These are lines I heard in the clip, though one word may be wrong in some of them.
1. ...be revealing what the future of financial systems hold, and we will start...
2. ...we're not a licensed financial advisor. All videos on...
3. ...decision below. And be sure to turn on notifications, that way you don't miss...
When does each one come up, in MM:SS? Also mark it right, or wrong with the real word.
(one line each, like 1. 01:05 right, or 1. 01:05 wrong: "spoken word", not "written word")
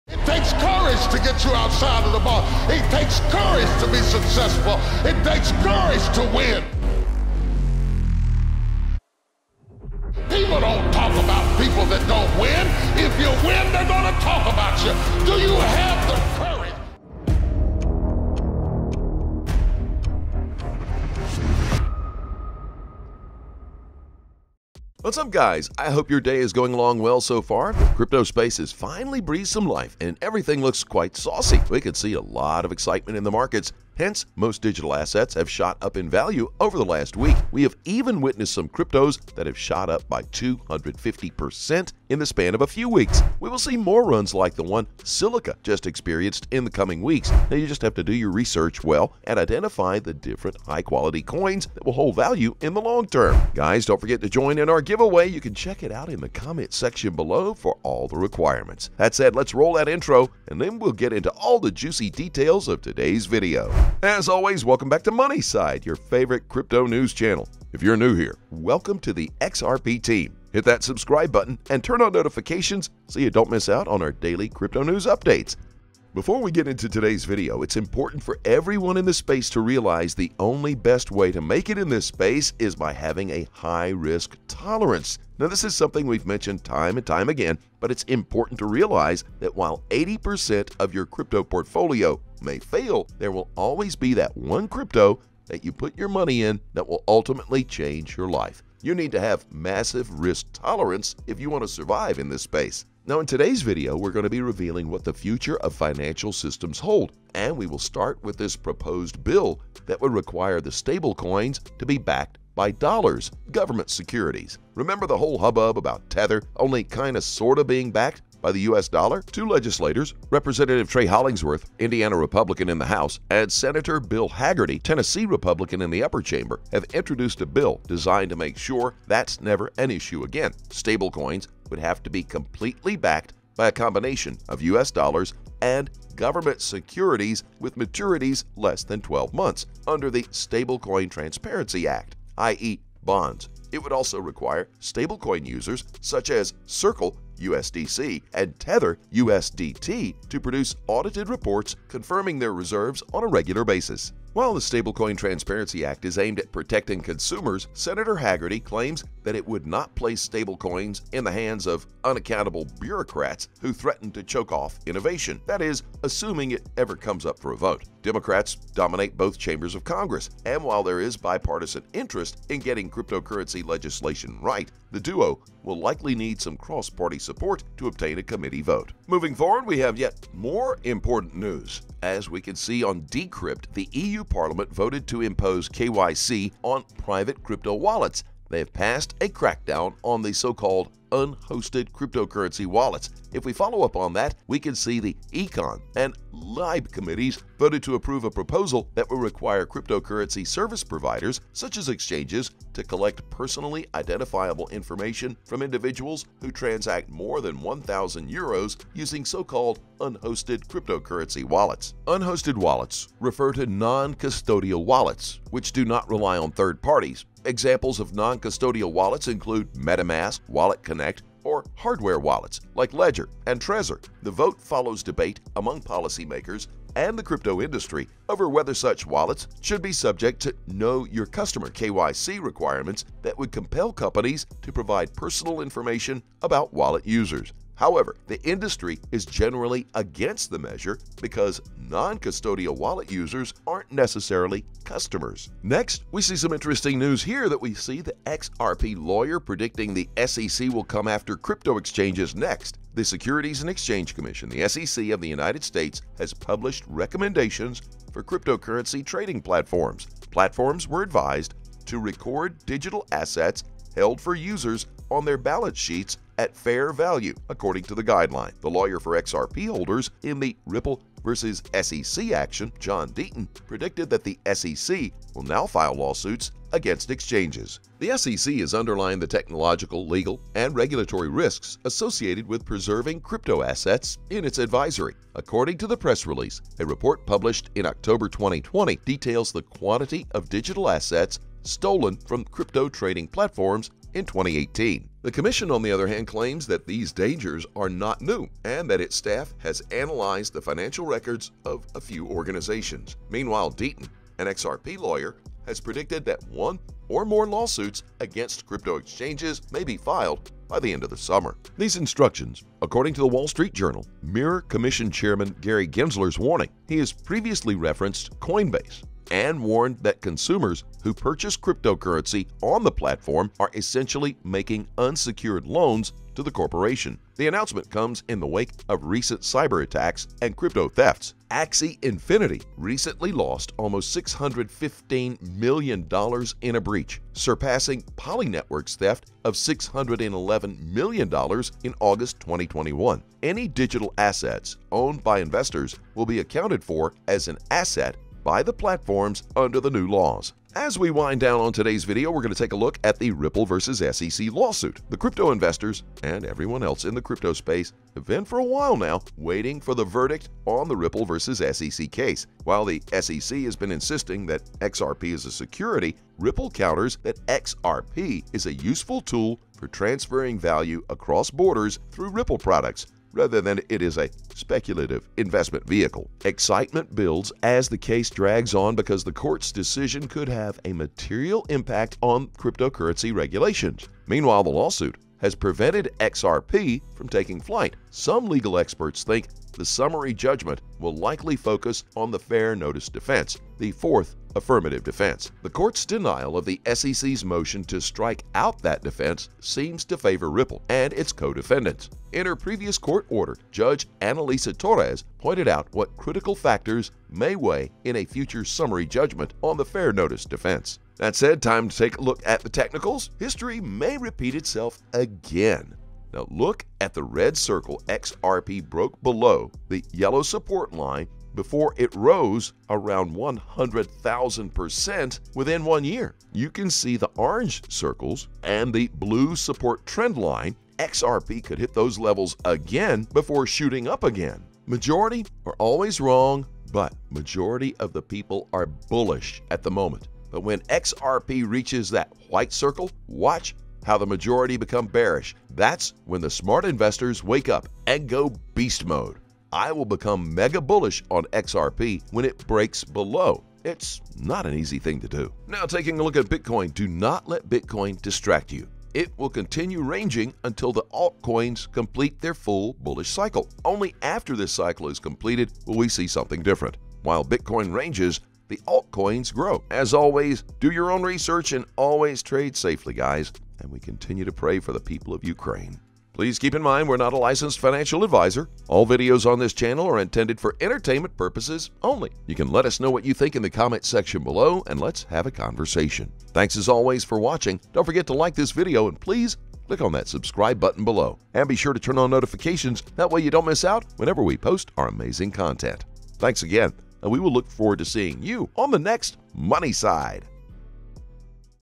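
1. 01:44 right
2. 07:57 right
3. 08:10 wrong: "button", not "decision".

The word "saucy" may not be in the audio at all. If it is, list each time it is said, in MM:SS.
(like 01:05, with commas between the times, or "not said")
00:31.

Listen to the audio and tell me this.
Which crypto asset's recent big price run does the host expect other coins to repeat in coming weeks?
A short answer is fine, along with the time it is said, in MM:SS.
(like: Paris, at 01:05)
Silica, at 00:45.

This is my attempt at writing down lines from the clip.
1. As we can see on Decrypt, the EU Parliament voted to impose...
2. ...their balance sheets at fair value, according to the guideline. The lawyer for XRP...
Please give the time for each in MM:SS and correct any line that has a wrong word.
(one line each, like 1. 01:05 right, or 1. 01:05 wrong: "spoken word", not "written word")
1. 03:02 right
2. 04:25 right.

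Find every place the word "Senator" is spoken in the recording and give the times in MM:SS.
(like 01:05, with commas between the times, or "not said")
02:03, 02:37.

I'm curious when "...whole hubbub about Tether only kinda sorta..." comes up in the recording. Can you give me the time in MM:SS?
01:55.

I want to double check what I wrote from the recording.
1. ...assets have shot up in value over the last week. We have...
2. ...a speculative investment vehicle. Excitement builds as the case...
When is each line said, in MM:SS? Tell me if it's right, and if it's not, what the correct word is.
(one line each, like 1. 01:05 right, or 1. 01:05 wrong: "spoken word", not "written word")
1. 00:34 right
2. 06:14 right.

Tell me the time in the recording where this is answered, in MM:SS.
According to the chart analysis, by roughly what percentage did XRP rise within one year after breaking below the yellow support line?
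07:03.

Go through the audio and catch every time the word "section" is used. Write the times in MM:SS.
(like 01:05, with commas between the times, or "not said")
00:56, 08:04.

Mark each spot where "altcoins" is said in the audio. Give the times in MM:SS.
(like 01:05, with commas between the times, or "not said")
07:41, 07:48.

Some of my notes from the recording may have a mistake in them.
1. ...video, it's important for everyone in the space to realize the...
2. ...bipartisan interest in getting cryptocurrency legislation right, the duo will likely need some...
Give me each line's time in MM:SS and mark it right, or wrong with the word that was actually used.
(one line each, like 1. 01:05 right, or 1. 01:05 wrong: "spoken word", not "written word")
1. 01:17 right
2. 02:51 right.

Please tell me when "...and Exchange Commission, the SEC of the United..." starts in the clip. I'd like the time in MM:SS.
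04:13.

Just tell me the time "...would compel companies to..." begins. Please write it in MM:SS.
03:53.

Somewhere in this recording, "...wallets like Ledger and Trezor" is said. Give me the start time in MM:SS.
03:42.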